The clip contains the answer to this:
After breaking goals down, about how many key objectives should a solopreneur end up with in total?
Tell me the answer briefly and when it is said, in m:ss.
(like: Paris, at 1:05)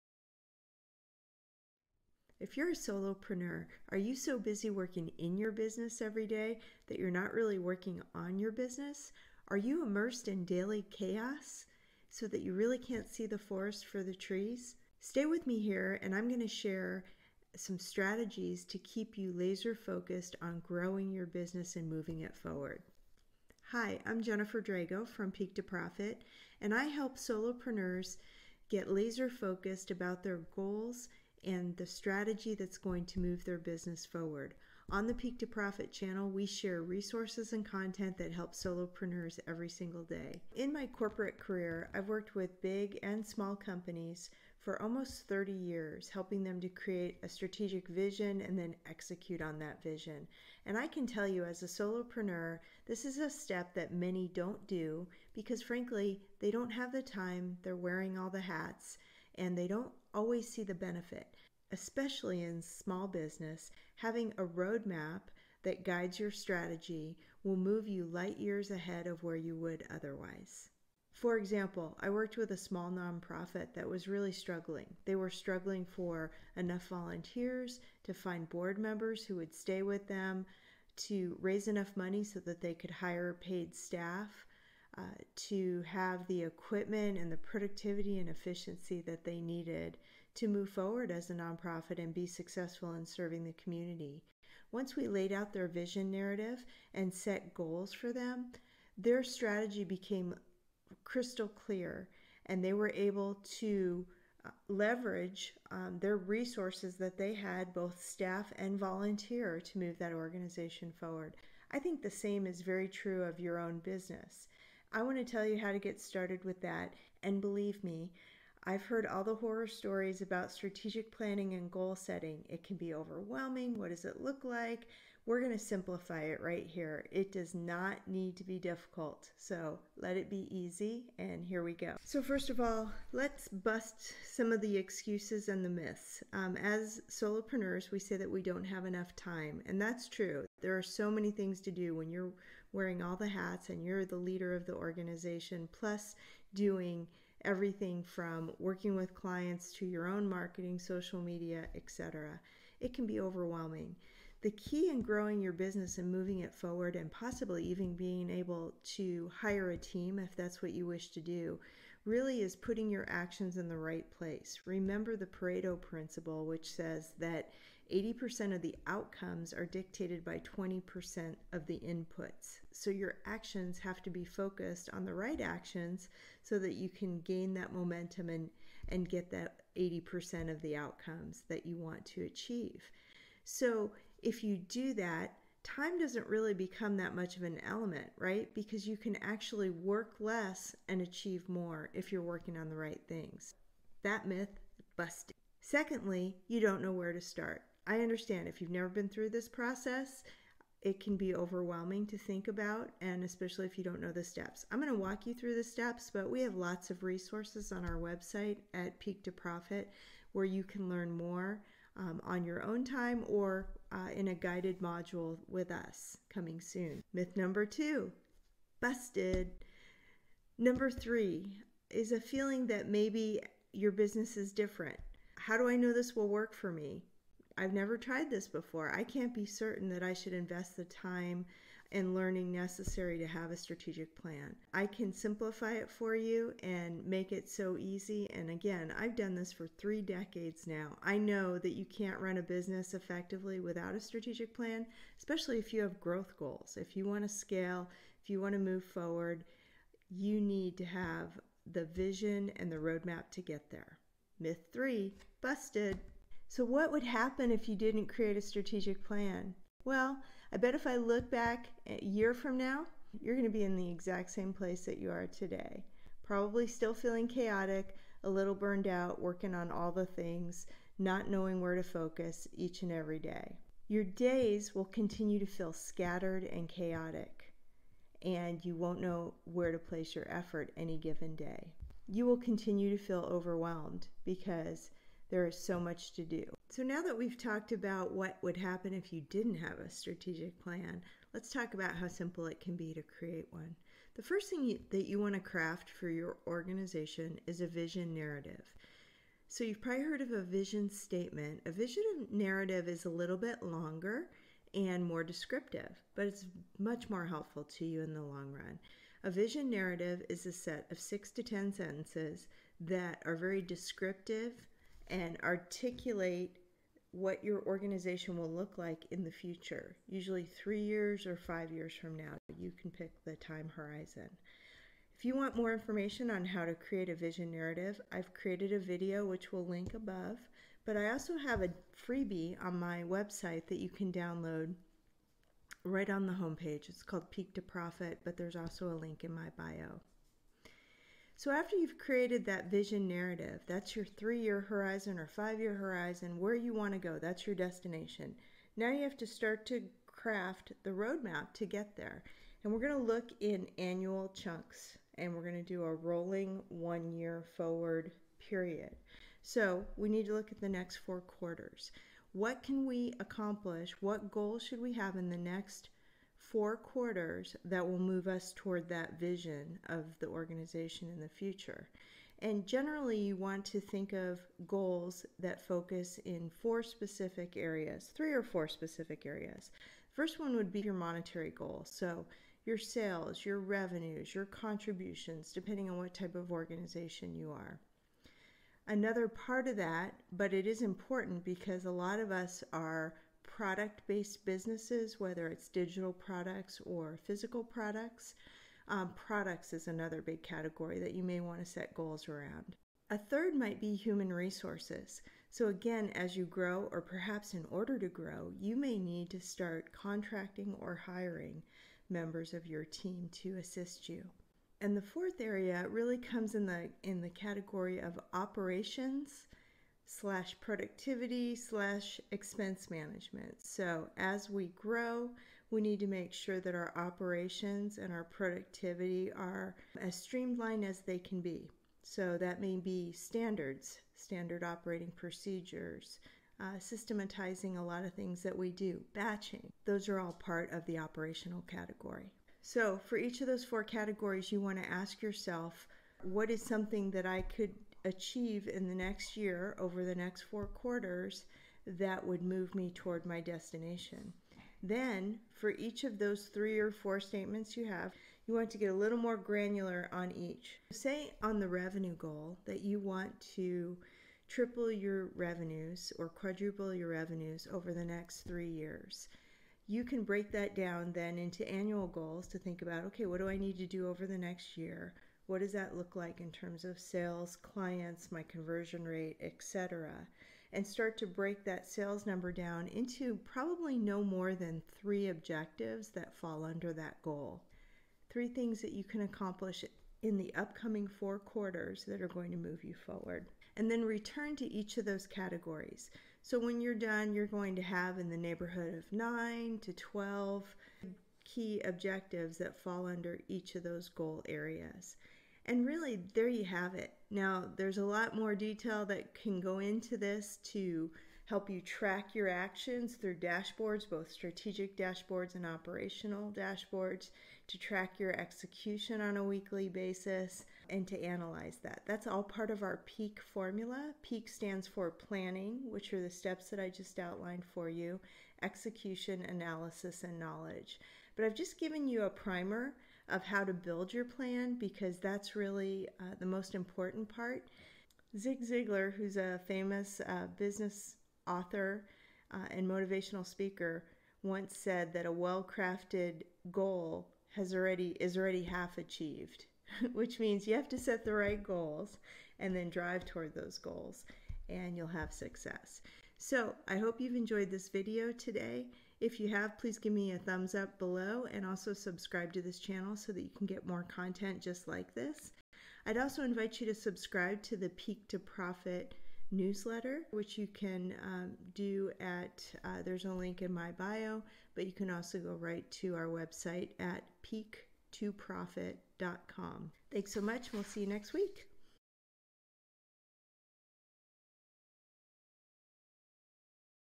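9 to 12, at 8:19.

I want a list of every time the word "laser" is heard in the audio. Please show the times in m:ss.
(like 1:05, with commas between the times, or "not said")
0:19, 0:28.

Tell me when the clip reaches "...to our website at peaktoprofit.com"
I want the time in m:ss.
9:35.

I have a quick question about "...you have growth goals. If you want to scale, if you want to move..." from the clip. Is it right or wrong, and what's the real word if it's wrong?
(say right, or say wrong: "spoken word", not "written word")
right.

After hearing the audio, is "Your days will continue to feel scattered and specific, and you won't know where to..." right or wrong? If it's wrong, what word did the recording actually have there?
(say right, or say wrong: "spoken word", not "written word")
wrong: "chaotic", not "specific".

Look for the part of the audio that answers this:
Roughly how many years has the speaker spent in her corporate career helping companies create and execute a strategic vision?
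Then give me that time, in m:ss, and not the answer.
0:44.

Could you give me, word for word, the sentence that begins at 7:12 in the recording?
So that may be standards, standard operating procedures, uh, systematizing a lot of things that we do, batching.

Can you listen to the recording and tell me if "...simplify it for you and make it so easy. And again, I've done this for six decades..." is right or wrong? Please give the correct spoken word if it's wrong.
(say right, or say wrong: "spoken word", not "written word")
wrong: "three", not "six".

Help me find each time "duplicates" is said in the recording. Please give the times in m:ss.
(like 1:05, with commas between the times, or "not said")
not said.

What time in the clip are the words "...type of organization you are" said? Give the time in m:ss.
6:26.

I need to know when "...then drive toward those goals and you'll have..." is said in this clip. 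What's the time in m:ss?
9:12.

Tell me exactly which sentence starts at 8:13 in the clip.
And then return to each of those categories.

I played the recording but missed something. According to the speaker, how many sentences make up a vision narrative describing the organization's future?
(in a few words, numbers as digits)
6 to 10.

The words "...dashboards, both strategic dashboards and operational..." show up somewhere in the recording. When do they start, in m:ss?
8:33.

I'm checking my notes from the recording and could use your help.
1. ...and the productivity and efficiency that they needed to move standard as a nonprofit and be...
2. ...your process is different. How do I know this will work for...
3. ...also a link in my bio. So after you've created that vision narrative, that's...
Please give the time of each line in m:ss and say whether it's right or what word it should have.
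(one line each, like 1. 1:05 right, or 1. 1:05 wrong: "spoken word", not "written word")
1. 1:27 wrong: "forward", not "standard"
2. 3:43 wrong: "business", not "process"
3. 5:38 right.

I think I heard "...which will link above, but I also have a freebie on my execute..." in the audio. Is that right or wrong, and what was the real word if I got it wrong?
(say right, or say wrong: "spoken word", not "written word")
wrong: "website", not "execute".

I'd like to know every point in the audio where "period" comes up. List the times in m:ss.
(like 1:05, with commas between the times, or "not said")
5:58.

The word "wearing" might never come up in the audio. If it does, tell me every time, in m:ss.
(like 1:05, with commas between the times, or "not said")
0:57, 2:22.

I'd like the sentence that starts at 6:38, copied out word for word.
Um, products is another big category that you may want to set goals around.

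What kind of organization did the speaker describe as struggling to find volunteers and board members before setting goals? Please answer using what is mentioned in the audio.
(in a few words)
small nonprofit.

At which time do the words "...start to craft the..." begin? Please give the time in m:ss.
5:49.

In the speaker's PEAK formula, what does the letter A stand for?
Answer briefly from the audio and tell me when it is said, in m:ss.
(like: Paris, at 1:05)
analysis, at 8:49.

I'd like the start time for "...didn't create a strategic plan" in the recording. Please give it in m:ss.
4:17.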